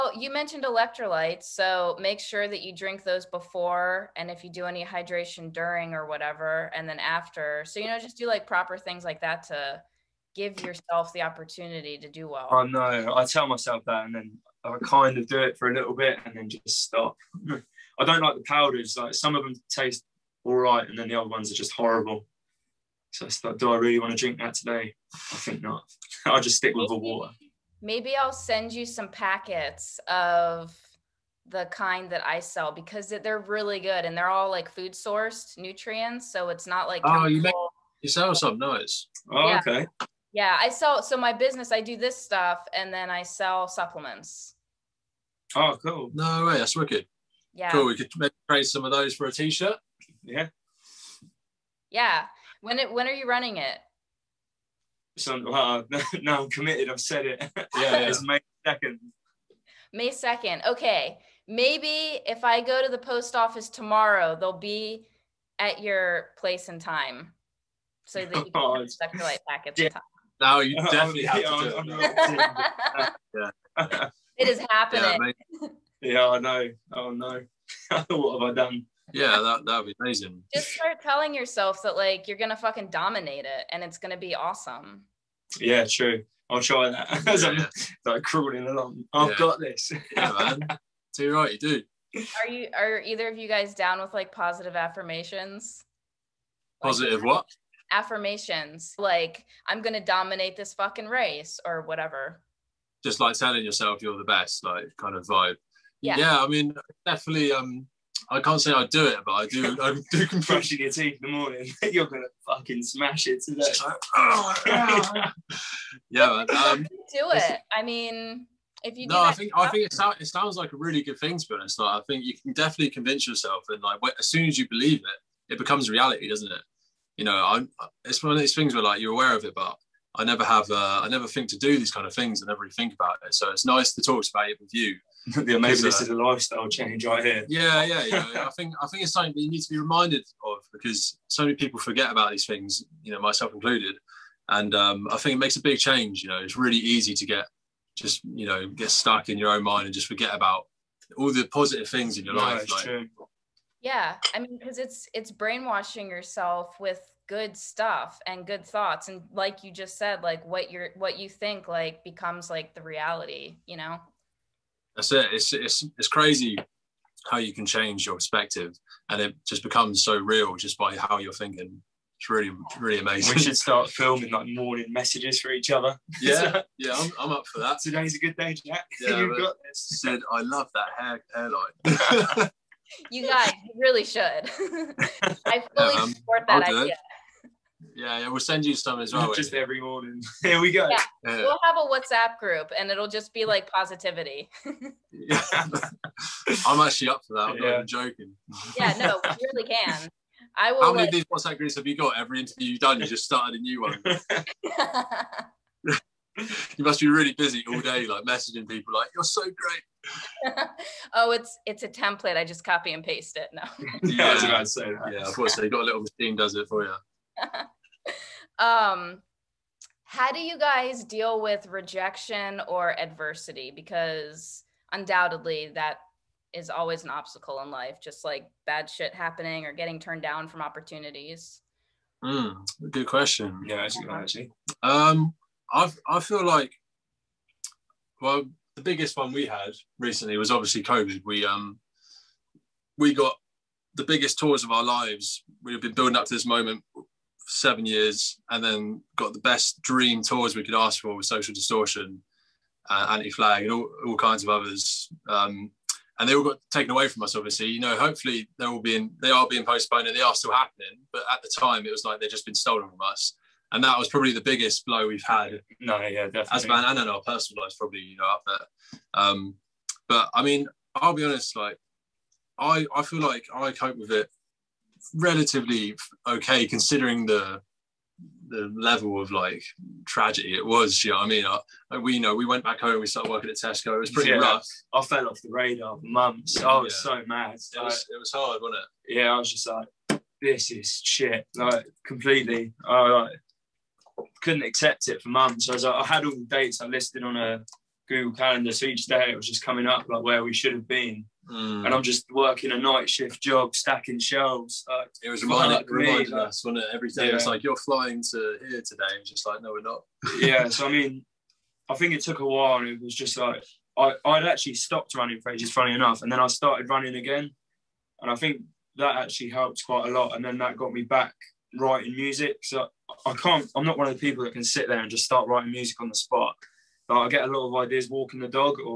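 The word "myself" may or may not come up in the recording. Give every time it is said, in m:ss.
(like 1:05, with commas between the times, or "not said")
0:13, 2:23.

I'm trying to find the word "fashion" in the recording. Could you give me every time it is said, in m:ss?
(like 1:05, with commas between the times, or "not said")
not said.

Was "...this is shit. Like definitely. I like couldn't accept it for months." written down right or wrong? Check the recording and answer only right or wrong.
wrong.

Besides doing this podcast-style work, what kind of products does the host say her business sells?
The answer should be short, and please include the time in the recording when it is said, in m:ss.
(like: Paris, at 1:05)
supplements, at 0:43.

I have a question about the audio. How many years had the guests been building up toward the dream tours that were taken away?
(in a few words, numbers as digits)
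7.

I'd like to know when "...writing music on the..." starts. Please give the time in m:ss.
5:25.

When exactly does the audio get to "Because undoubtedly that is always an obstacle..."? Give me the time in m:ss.
3:43.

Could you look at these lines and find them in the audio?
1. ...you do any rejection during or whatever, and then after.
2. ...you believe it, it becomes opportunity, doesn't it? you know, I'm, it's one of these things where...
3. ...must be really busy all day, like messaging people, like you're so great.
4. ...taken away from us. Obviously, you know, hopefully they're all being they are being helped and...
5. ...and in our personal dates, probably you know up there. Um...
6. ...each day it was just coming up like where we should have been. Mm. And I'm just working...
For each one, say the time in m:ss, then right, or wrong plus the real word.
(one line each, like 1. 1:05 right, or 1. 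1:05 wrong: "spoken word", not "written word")
1. 0:04 wrong: "hydration", not "rejection"
2. 2:04 wrong: "reality", not "opportunity"
3. 3:26 right
4. 4:16 wrong: "postponed", not "helped"
5. 4:26 wrong: "lives", not "dates"
6. 4:58 right.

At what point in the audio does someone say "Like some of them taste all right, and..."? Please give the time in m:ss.
0:18.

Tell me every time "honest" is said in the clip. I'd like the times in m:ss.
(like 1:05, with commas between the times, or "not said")
2:01, 4:31.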